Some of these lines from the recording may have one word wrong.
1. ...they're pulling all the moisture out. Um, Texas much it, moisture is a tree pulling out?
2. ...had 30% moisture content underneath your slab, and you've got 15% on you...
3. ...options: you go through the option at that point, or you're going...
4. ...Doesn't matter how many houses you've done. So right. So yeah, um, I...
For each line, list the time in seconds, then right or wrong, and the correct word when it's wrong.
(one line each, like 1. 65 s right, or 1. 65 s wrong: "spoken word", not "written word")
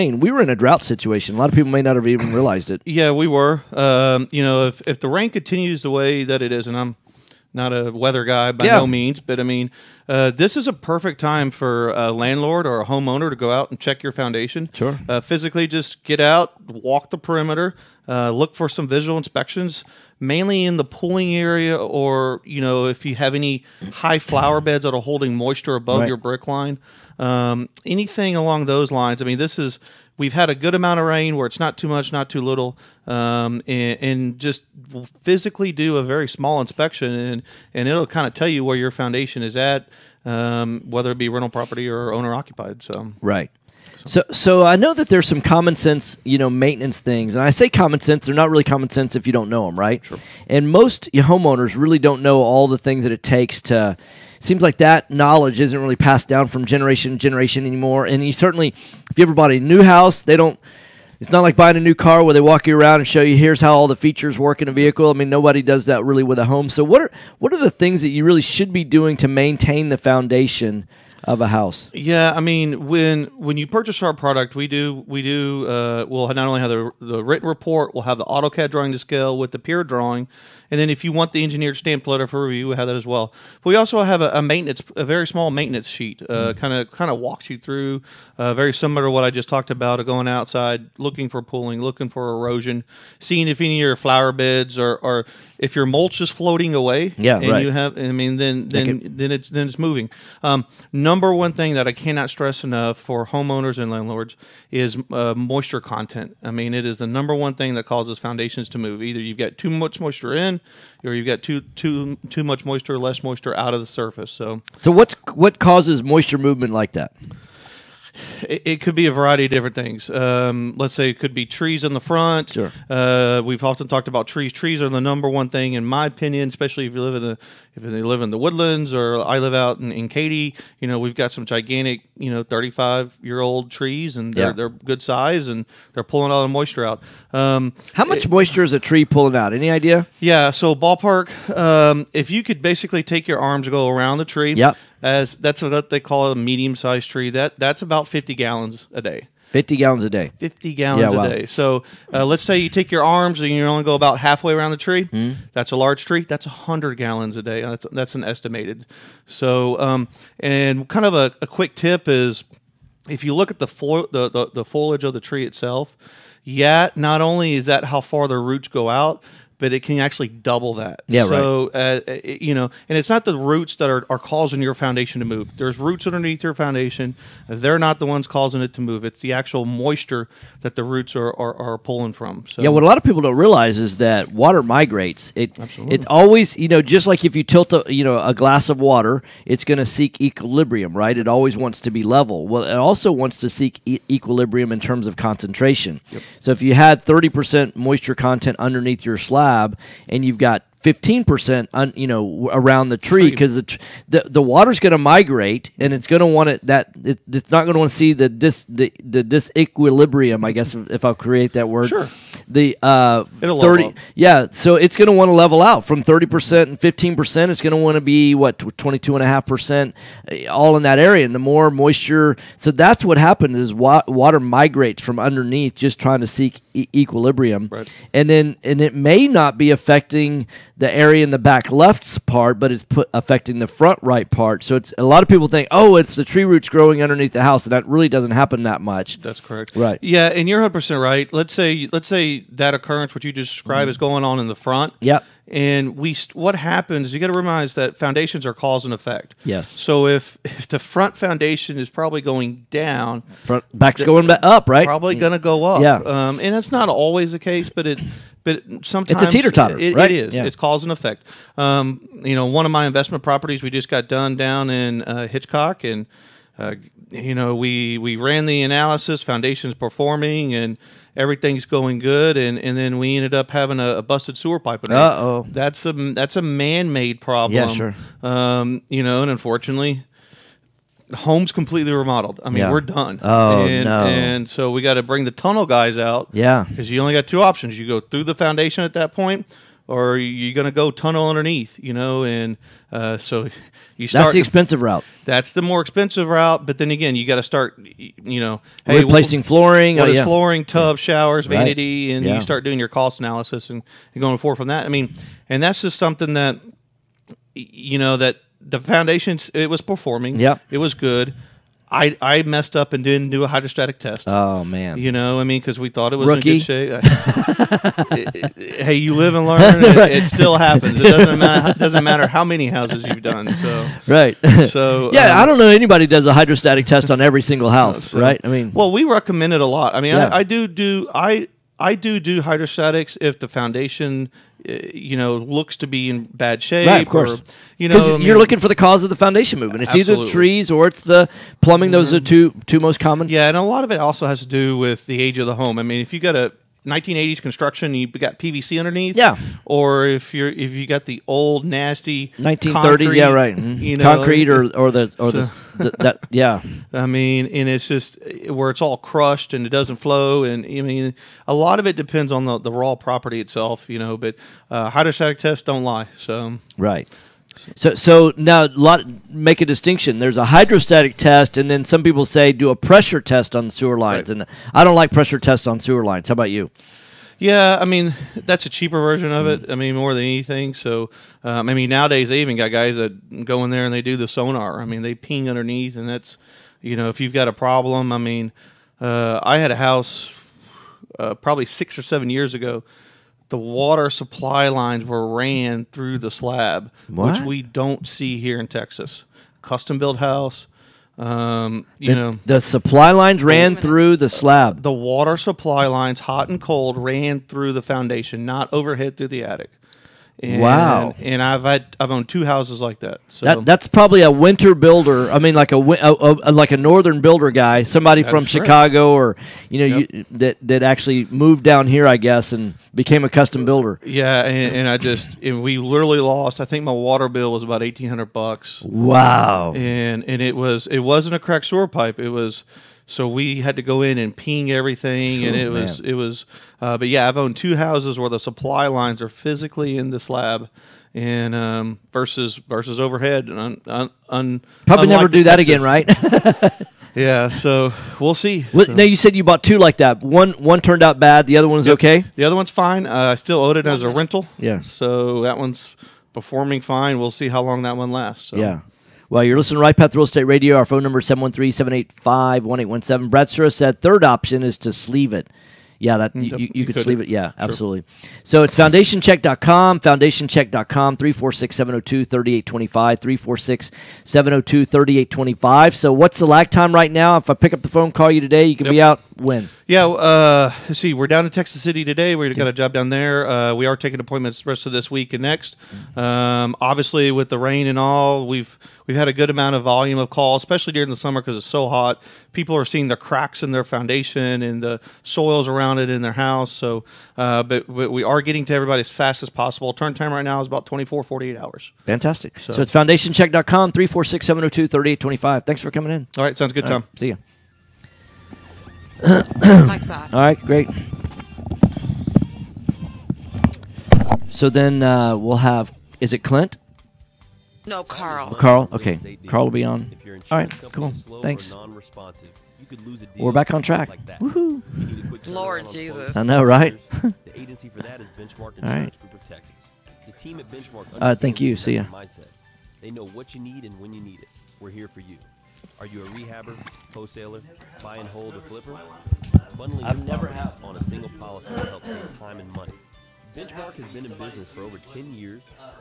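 1. 135 s wrong: "How", not "Texas"
2. 196 s right
3. 287 s wrong: "foundation", not "option"
4. 321 s right.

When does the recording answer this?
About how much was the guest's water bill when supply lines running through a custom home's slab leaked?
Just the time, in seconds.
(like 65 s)
427 s.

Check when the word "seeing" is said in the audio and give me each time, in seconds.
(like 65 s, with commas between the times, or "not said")
93 s, 492 s.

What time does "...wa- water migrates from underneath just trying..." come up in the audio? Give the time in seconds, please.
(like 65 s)
223 s.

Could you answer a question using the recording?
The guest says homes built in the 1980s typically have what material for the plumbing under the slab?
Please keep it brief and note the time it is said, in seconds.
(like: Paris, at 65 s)
PVC, at 348 s.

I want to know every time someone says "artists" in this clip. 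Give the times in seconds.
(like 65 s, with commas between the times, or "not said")
not said.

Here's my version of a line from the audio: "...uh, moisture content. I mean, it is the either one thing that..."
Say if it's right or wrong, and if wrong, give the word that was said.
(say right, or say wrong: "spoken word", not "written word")
wrong: "number", not "either".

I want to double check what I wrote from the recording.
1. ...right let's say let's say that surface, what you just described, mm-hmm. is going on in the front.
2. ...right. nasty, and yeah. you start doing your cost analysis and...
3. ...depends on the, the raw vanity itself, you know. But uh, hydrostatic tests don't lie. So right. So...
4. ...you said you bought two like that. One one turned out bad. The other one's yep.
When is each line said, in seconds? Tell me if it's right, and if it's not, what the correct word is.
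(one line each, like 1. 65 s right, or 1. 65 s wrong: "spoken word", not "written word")
1. 241 s wrong: "occurrence", not "surface"
2. 301 s wrong: "vanity", not "nasty"
3. 361 s wrong: "property", not "vanity"
4. 449 s right.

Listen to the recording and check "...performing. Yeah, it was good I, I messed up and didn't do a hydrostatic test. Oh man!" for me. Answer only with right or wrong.
right.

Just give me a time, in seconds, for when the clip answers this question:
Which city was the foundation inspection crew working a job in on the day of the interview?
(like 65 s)
481 s.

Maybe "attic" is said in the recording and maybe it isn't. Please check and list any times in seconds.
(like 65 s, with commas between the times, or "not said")
409 s.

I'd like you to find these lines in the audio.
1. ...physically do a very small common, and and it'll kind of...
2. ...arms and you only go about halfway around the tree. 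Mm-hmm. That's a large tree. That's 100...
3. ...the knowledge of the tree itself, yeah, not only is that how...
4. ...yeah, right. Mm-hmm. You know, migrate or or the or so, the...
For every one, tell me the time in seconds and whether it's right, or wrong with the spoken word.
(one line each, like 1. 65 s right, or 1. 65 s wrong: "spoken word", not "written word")
1. 35 s wrong: "inspection", not "common"
2. 153 s right
3. 164 s wrong: "foliage", not "knowledge"
4. 353 s wrong: "concrete", not "migrate".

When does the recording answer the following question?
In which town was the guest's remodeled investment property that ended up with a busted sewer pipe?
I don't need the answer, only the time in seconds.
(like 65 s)
265 s.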